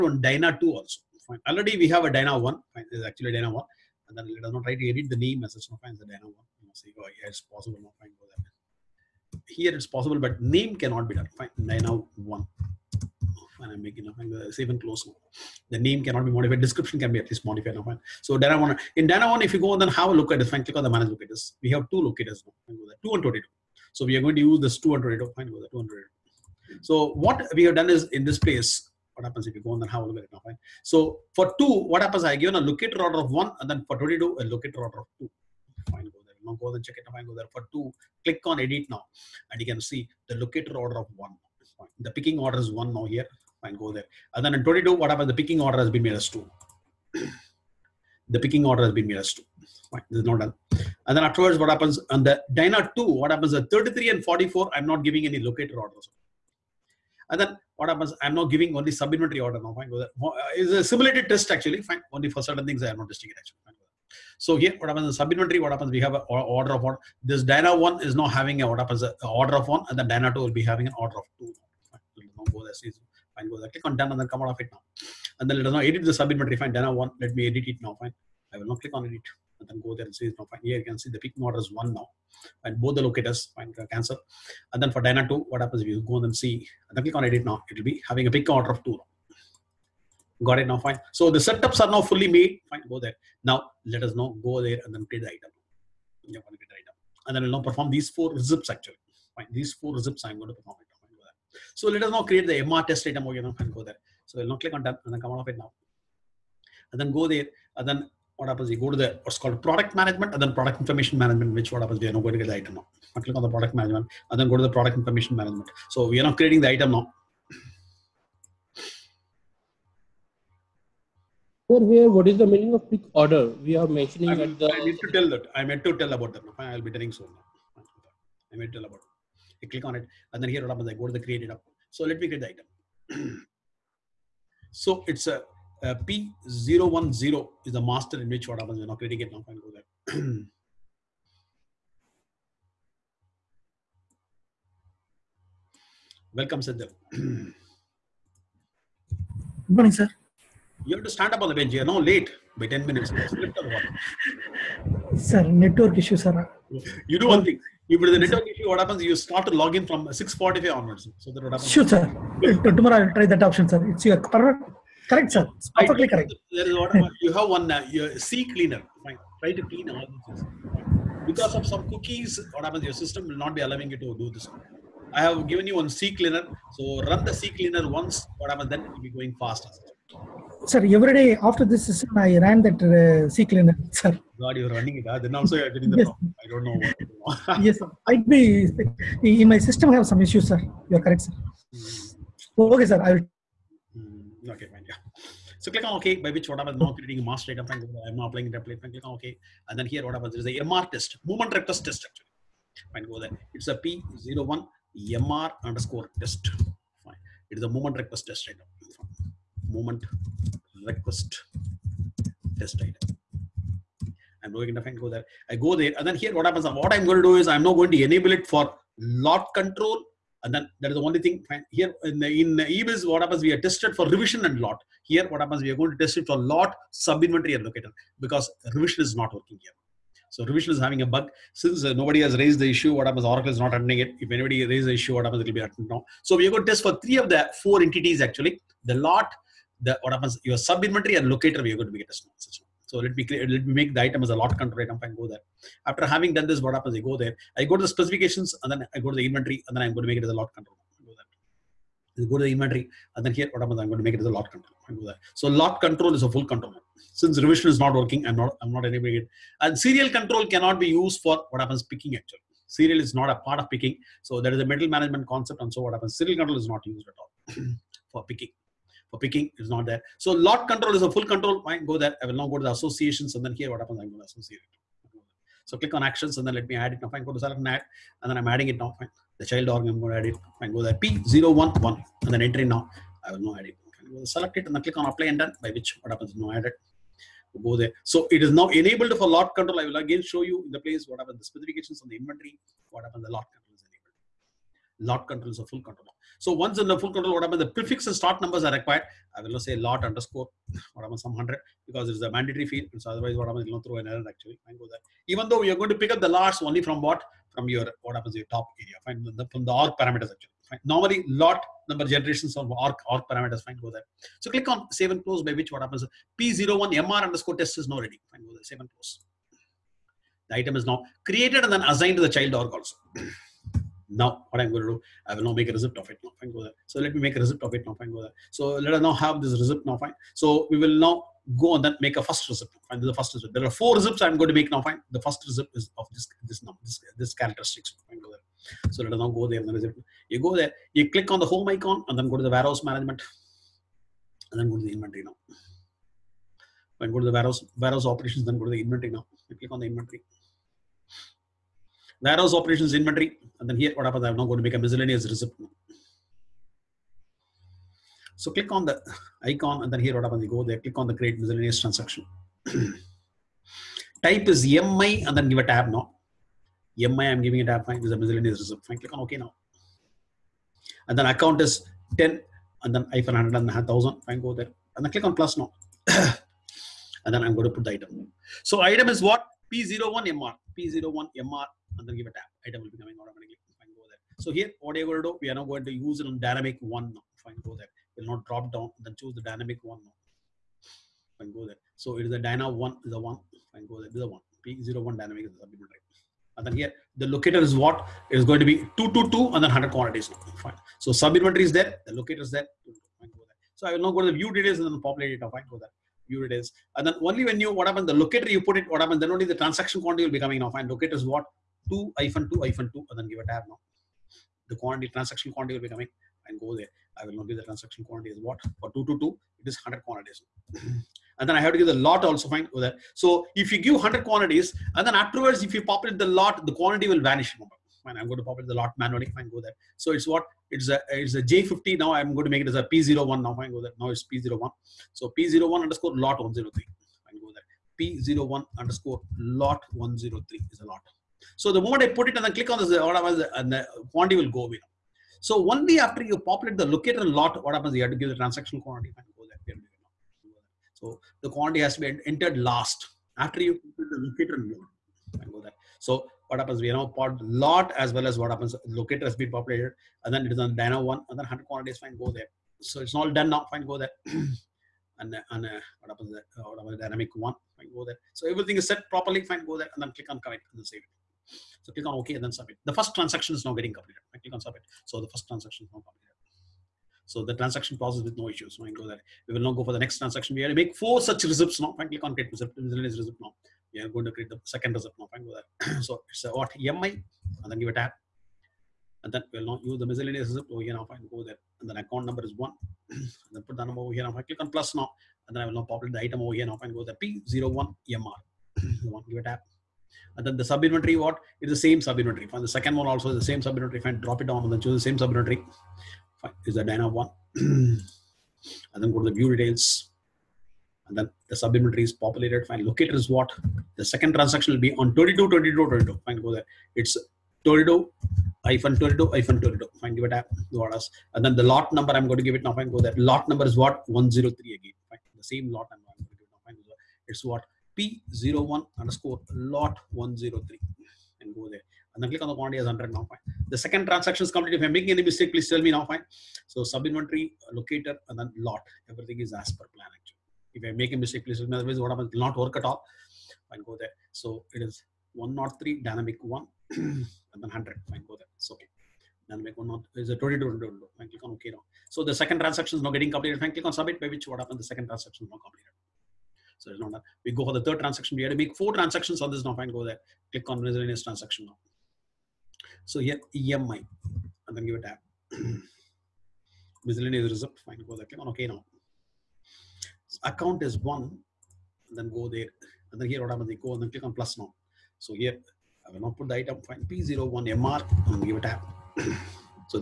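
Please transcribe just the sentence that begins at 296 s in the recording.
So once in the full control, what happens, the prefix and start numbers are required.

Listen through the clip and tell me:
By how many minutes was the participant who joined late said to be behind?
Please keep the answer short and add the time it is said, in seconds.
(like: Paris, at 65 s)
10 minutes, at 151 s.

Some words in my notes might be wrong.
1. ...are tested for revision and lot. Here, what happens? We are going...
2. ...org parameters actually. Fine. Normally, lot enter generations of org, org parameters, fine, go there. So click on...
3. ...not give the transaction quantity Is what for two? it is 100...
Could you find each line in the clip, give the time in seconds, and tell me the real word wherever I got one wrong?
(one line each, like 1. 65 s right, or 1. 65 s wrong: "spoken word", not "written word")
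1. 223 s right
2. 309 s wrong: "number", not "enter"
3. 417 s right.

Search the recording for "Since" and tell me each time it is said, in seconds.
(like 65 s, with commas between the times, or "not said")
231 s, 257 s.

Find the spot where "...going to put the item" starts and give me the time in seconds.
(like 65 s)
377 s.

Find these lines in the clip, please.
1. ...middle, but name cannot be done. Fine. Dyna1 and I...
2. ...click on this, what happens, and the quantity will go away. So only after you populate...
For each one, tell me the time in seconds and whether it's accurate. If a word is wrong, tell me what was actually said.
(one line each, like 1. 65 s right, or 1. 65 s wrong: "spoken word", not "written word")
1. 9 s wrong: "possible", not "middle"
2. 442 s right.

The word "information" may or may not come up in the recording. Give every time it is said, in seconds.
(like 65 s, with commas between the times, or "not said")
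110 s, 114 s.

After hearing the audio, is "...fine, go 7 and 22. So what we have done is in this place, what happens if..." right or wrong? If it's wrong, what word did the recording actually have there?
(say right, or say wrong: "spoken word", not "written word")
wrong: "2", not "7".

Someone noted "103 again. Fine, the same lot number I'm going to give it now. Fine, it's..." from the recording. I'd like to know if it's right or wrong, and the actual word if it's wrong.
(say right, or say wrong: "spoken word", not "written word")
right.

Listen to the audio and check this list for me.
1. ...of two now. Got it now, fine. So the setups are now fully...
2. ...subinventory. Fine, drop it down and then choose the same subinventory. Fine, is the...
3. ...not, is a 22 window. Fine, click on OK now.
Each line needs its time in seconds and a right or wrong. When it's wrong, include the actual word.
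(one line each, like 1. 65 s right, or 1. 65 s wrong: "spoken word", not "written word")
1. 88 s right
2. 503 s right
3. 549 s right.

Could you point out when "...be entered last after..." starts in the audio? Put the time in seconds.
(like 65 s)
452 s.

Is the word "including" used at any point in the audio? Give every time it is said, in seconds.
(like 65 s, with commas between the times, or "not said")
not said.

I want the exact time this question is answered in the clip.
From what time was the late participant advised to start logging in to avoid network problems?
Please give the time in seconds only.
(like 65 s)
160 s.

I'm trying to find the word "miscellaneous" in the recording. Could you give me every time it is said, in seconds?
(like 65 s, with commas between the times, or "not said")
354 s, 361 s, 368 s, 482 s, 490 s, 560 s, 567 s.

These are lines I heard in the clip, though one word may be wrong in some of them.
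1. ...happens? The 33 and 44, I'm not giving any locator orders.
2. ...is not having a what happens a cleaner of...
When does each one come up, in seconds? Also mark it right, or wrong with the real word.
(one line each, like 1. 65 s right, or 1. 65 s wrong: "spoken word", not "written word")
1. 53 s right
2. 68 s wrong: "order", not "cleaner".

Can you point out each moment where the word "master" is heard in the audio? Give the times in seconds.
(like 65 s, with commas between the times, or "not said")
137 s, 197 s.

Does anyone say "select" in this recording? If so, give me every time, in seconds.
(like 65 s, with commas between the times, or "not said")
277 s, 284 s.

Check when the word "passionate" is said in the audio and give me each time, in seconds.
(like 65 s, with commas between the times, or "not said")
not said.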